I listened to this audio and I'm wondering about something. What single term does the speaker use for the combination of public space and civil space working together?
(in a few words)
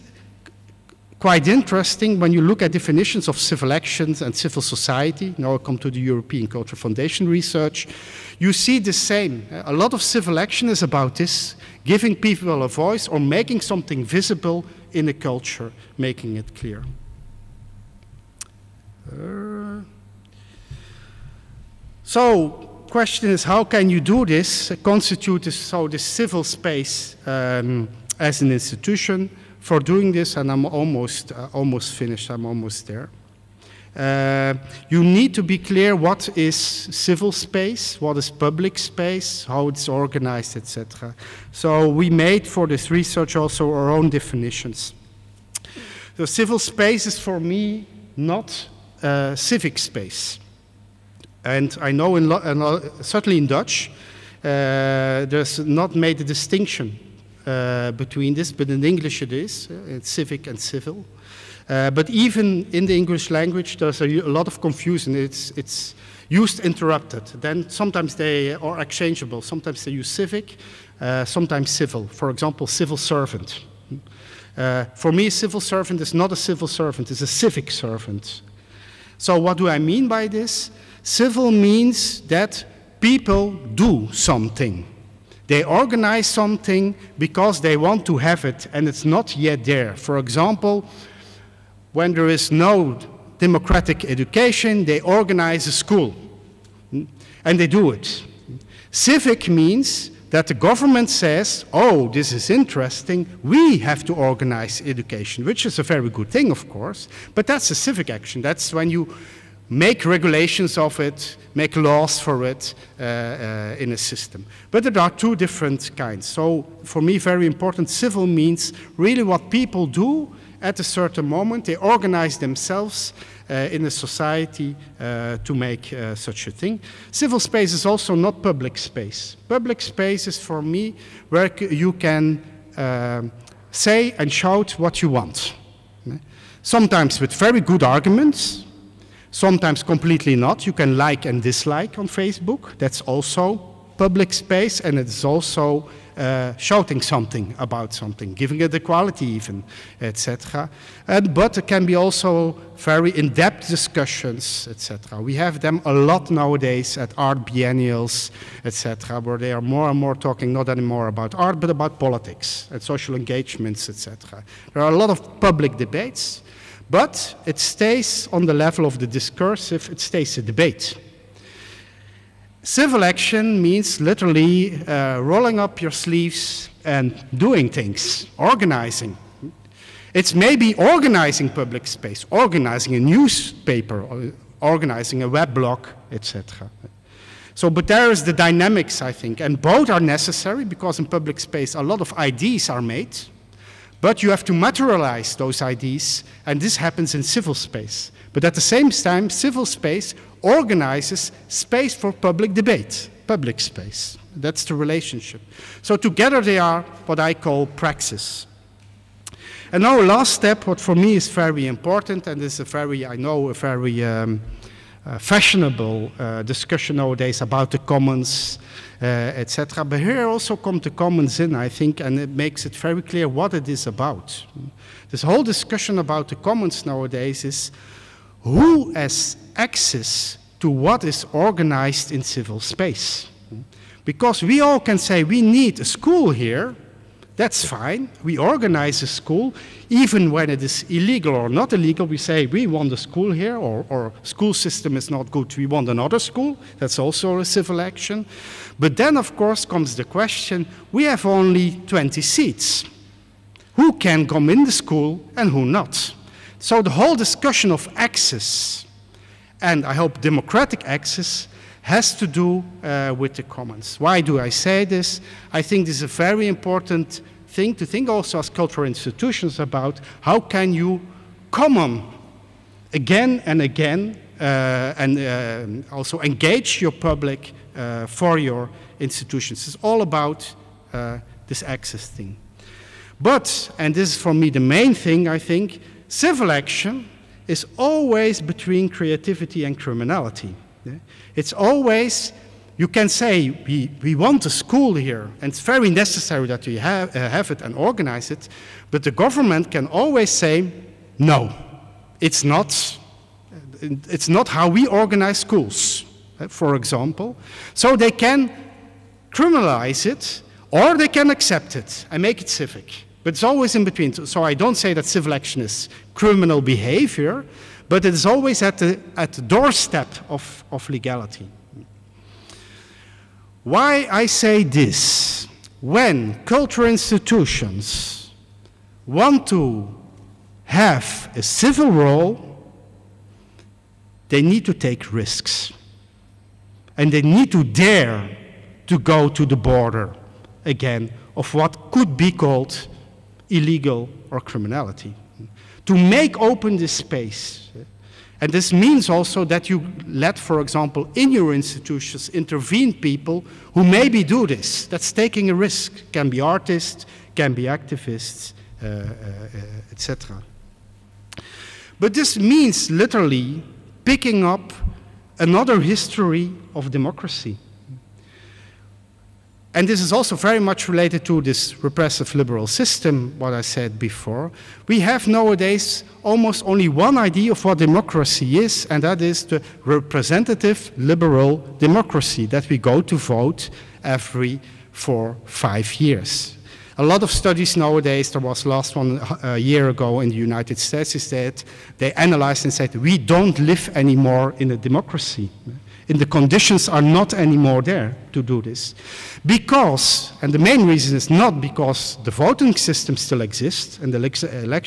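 praxis.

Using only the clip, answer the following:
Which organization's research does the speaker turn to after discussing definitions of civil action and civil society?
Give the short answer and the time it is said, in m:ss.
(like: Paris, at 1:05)
European Cultural Foundation, at 0:05.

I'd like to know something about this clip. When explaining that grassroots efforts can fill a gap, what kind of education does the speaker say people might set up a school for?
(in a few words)
democratic education.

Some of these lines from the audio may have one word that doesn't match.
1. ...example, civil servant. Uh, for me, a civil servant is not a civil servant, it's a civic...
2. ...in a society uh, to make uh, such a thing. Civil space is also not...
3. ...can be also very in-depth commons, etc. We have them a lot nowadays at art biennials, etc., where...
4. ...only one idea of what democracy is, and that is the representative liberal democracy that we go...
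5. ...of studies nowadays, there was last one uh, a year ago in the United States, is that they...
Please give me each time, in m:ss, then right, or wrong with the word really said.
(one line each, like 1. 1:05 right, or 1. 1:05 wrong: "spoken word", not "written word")
1. 1:12 right
2. 2:03 right
3. 2:31 wrong: "discussions", not "commons"
4. 6:16 right
5. 6:27 right.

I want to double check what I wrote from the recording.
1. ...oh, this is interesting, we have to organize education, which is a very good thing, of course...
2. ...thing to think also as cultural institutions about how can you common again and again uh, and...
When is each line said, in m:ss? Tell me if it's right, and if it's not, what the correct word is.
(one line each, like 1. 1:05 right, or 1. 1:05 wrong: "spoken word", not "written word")
1. 1:41 right
2. 4:27 right.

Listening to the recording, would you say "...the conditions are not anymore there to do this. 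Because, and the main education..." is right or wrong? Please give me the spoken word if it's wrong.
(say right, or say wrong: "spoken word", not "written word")
wrong: "reason", not "education".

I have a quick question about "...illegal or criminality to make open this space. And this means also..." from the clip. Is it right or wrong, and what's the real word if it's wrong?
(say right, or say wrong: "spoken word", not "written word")
right.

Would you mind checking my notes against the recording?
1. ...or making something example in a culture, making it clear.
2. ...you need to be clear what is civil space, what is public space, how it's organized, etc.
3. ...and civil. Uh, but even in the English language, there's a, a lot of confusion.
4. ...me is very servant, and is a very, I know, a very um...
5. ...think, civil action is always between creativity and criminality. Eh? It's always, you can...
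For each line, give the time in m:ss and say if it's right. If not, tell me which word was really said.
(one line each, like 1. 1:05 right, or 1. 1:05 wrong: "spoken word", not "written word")
1. 0:13 wrong: "visible", not "example"
2. 0:34 right
3. 1:00 right
4. 3:30 wrong: "important", not "servant"
5. 4:45 right.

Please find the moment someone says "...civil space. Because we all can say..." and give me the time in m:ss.
3:52.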